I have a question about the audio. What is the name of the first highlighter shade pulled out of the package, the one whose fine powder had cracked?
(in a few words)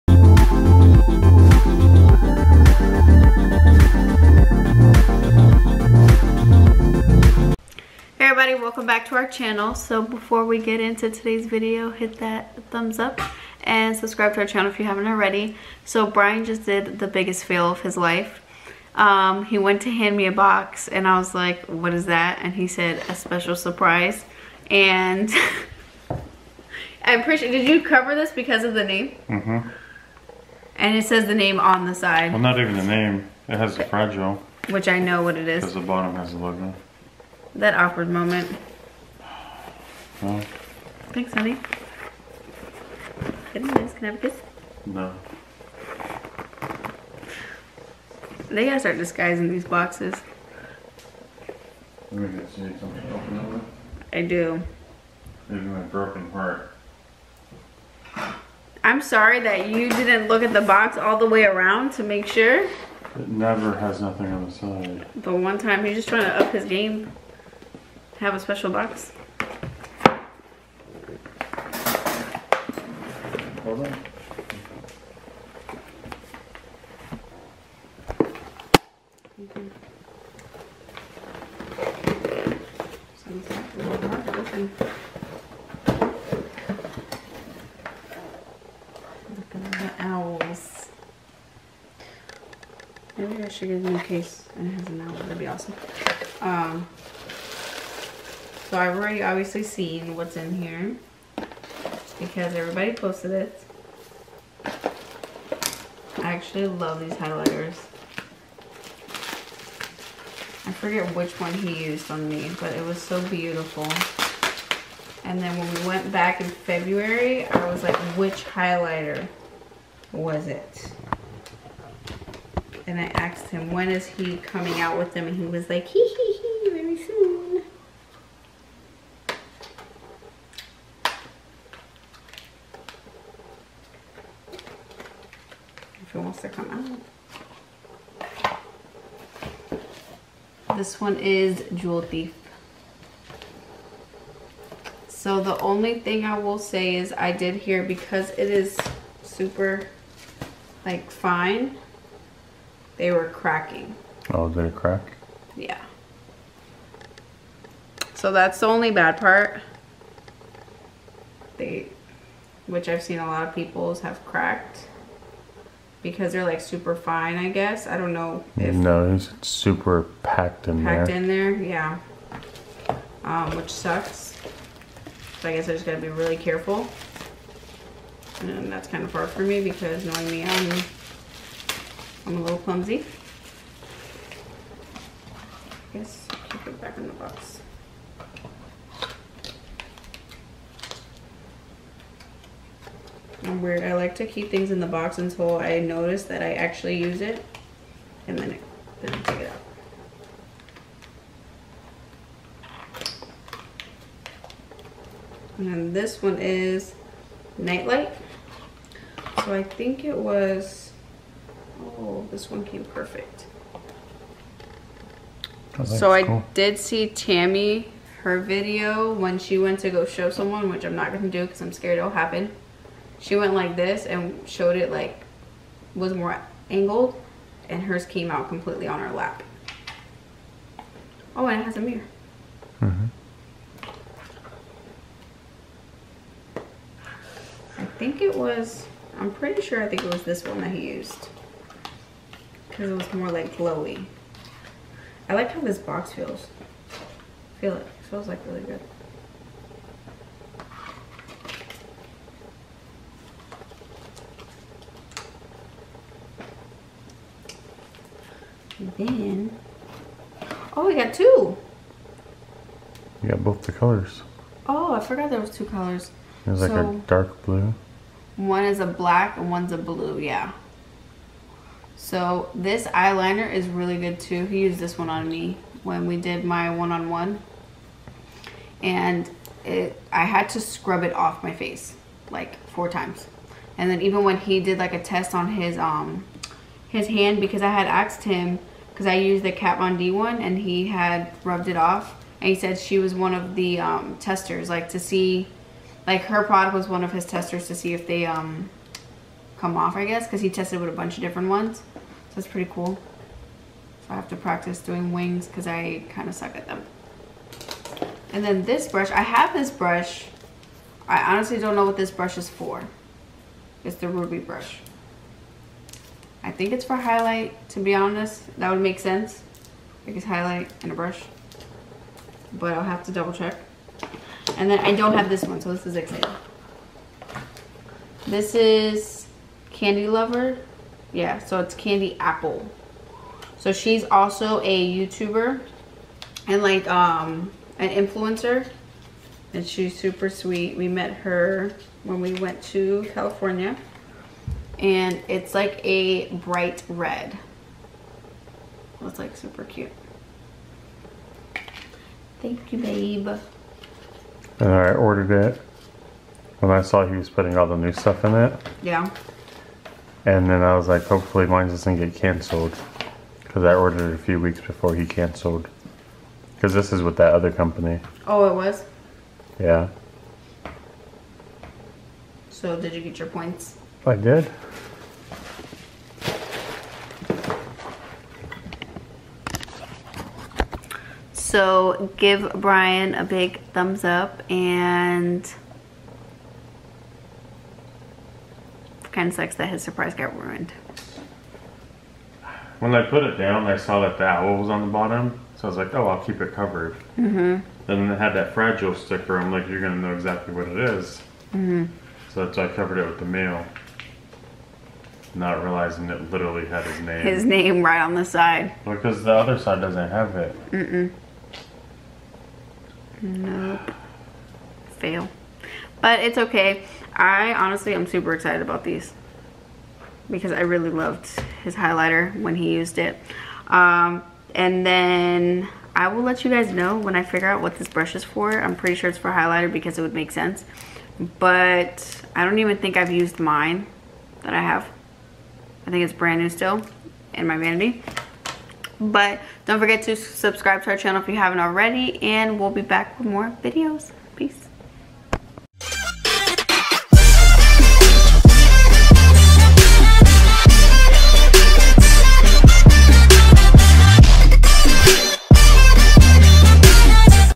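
Jewel Thief.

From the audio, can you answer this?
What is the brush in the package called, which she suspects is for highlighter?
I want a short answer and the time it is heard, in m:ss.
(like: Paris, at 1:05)
ruby brush, at 5:14.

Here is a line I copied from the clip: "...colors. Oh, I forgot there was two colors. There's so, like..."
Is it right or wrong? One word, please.
right.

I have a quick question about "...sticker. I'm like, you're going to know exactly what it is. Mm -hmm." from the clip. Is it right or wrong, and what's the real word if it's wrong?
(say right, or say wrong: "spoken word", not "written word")
right.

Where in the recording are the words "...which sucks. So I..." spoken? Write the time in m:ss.
2:53.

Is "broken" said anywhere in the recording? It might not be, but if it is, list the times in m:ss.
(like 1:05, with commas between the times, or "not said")
0:55.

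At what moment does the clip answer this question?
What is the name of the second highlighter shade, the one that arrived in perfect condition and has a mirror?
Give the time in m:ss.
3:27.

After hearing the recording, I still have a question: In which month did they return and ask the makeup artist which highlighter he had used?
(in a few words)
February.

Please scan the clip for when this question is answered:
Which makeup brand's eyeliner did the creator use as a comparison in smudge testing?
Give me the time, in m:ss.
4:49.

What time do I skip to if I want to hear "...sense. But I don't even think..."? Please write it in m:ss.
7:10.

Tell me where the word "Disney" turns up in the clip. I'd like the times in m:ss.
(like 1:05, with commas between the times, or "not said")
not said.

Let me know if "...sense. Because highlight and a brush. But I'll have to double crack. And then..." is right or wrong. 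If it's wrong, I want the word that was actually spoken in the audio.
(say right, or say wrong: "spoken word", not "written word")
wrong: "check", not "crack".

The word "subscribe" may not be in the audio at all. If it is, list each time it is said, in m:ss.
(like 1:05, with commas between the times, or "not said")
0:13, 7:20.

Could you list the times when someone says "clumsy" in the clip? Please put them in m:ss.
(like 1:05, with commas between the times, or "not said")
3:02.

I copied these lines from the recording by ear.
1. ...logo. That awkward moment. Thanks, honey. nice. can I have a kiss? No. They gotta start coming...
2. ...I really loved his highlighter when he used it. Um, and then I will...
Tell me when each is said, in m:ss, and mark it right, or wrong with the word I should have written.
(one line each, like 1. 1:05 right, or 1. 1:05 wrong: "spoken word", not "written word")
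1. 0:36 wrong: "disguising", not "coming"
2. 7:00 right.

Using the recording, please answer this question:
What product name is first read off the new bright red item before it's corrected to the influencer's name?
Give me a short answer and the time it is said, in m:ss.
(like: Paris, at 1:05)
Candy Lover, at 5:29.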